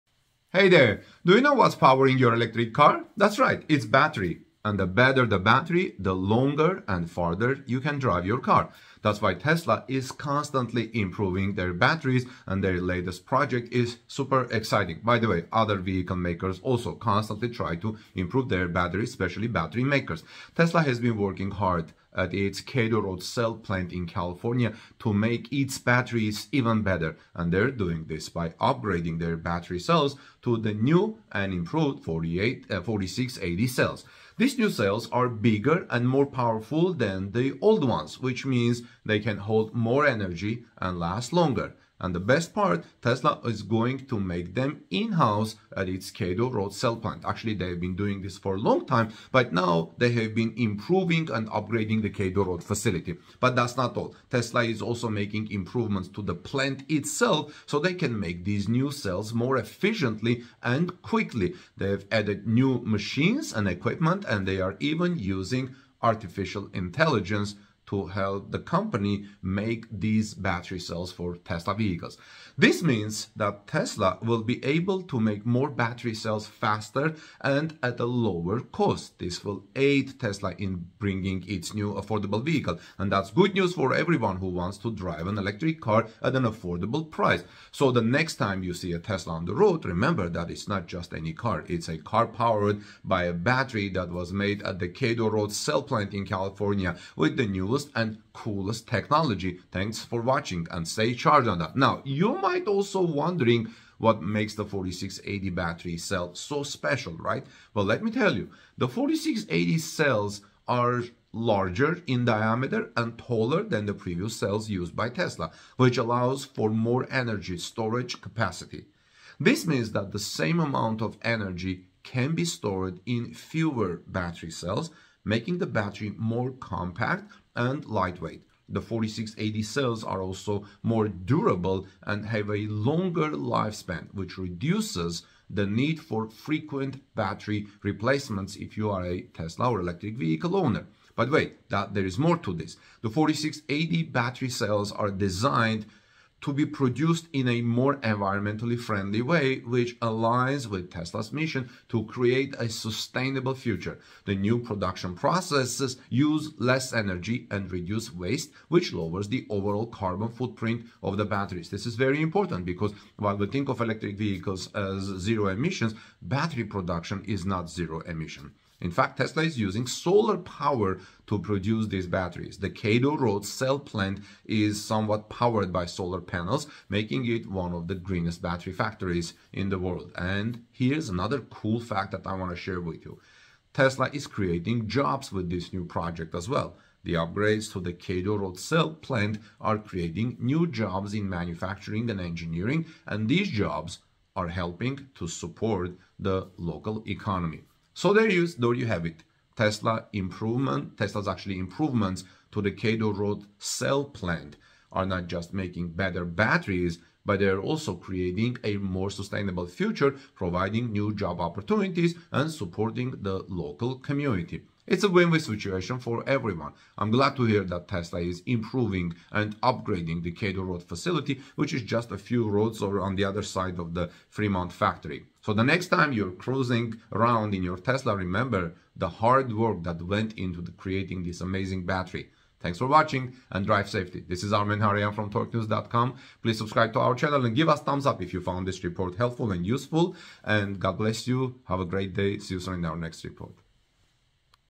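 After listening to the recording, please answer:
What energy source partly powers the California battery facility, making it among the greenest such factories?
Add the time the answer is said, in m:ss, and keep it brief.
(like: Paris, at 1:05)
solar panels, at 2:55.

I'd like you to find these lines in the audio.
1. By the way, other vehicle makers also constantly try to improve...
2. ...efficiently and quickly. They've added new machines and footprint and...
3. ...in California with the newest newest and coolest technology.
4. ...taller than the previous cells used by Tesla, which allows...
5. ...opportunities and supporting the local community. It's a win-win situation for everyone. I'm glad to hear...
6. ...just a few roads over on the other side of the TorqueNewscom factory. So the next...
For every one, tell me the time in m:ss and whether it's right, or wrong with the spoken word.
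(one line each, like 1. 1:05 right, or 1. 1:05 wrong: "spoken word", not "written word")
1. 0:15 right
2. 0:59 wrong: "equipment", not "footprint"
3. 1:36 right
4. 1:53 right
5. 3:31 right
6. 3:41 wrong: "Fremont", not "TorqueNewscom".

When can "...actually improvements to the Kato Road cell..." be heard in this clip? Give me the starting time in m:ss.
3:21.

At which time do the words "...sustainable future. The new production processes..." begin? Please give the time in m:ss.
2:32.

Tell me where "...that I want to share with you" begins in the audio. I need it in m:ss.
3:02.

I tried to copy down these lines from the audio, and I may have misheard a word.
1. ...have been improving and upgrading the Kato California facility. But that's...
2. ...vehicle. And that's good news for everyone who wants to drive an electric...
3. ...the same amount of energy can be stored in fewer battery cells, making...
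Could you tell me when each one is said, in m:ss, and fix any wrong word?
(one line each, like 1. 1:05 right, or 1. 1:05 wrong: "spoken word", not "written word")
1. 0:50 wrong: "Road", not "California"
2. 1:22 right
3. 2:00 right.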